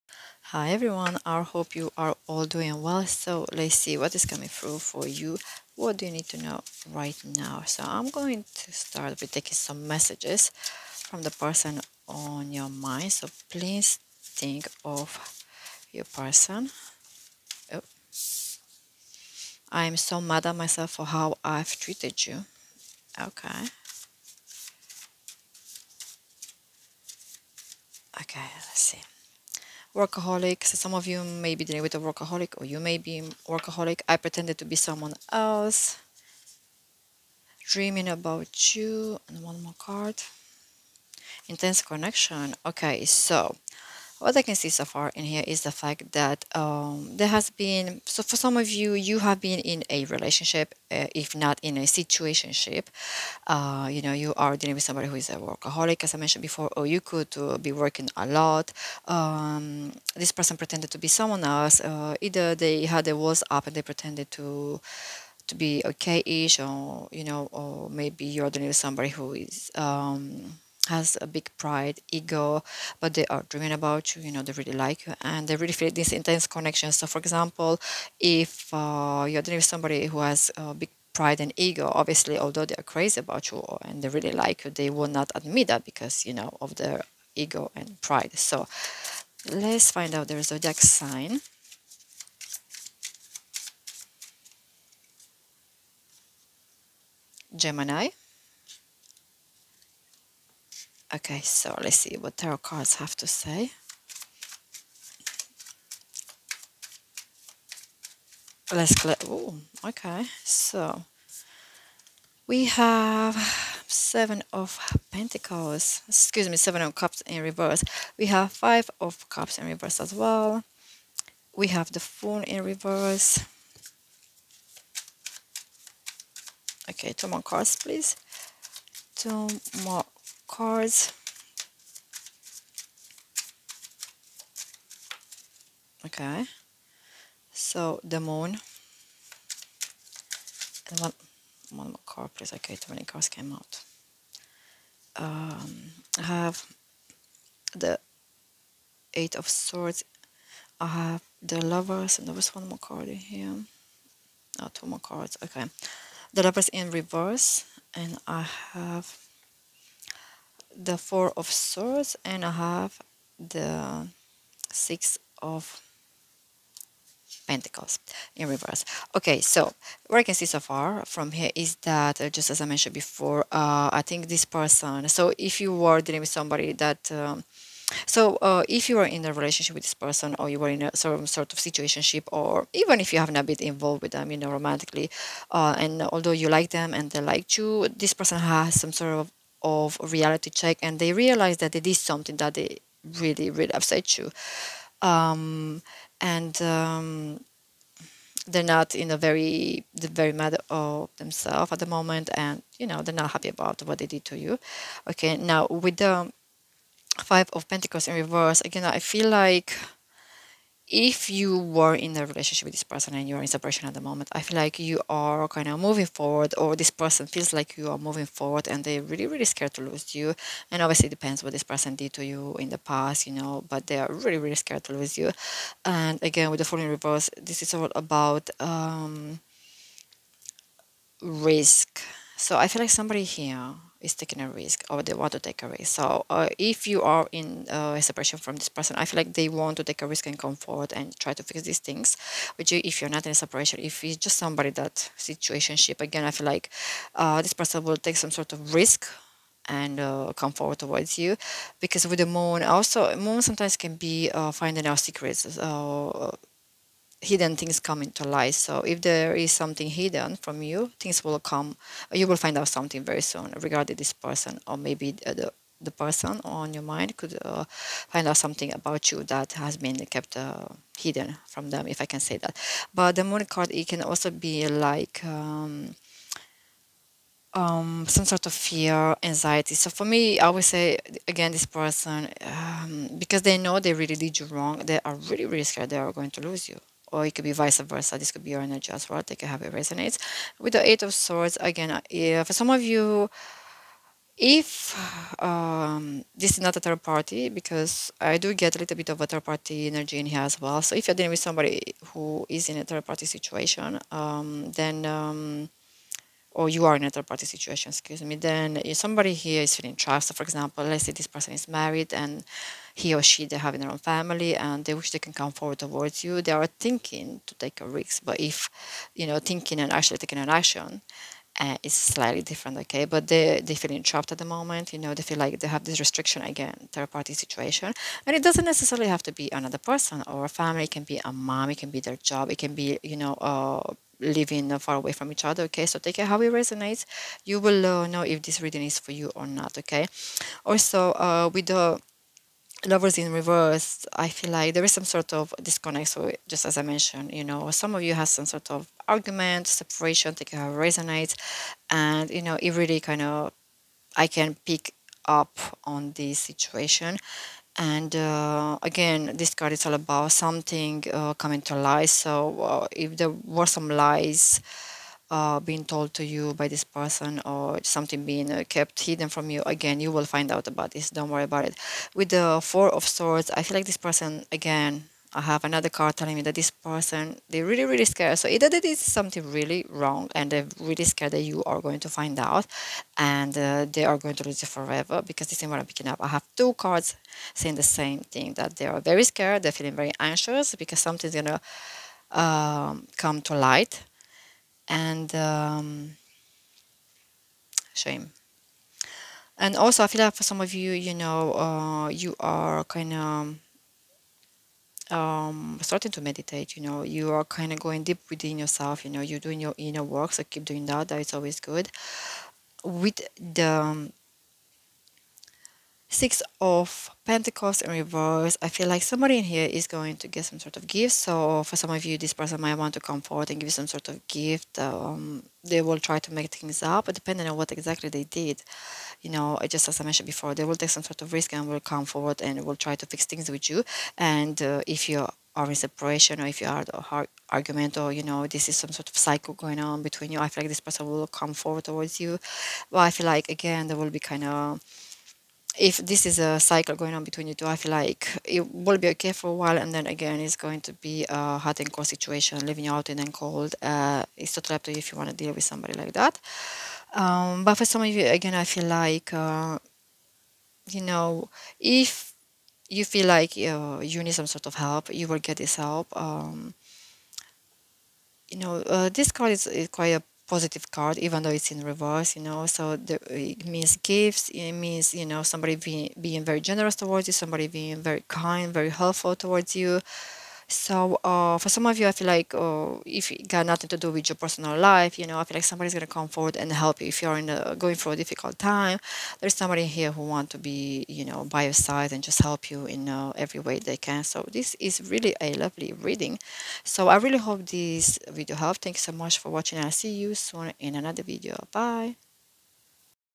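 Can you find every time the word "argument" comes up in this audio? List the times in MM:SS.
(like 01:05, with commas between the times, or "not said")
05:49, 07:17.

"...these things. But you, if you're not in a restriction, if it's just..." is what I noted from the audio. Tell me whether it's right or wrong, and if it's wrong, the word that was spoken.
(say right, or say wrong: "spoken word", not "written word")
wrong: "separation", not "restriction".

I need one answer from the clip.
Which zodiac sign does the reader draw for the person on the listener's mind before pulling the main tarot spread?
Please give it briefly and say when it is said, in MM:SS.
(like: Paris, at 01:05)
Gemini, at 01:37.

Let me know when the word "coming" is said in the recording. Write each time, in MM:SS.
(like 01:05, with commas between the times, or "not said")
00:04, 06:01.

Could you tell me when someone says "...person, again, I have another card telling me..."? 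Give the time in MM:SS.
06:13.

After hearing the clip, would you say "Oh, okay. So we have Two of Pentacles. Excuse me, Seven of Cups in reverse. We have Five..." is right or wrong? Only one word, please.
wrong.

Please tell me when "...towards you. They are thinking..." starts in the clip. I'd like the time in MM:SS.
05:15.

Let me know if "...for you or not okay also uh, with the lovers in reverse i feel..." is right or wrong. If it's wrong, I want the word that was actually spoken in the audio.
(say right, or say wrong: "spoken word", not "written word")
right.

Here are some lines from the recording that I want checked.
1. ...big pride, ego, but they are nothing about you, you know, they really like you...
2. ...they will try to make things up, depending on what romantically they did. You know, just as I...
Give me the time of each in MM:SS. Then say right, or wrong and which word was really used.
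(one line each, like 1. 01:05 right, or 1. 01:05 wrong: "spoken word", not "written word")
1. 01:11 wrong: "dreaming", not "nothing"
2. 07:05 wrong: "exactly", not "romantically".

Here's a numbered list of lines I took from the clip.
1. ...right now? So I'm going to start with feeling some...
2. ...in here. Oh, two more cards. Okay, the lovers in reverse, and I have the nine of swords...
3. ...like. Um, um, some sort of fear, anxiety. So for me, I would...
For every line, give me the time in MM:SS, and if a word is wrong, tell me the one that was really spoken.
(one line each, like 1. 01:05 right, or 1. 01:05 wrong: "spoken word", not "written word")
1. 00:06 wrong: "taking", not "feeling"
2. 02:33 wrong: "four", not "nine"
3. 04:34 right.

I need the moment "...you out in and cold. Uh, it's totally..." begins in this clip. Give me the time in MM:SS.
07:32.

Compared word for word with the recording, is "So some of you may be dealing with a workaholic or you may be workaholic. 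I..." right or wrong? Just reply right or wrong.
right.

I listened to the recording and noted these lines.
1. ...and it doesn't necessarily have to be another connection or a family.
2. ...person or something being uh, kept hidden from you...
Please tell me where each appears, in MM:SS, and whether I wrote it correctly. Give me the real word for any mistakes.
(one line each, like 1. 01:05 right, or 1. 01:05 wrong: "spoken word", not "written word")
1. 05:28 wrong: "person", not "connection"
2. 06:06 right.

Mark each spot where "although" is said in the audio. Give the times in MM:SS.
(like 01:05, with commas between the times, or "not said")
01:22, 03:06.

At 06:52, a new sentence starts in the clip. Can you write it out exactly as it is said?
With the um, Six of Pentacles in reverse.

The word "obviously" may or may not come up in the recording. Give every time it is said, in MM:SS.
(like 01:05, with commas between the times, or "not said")
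01:21, 03:40.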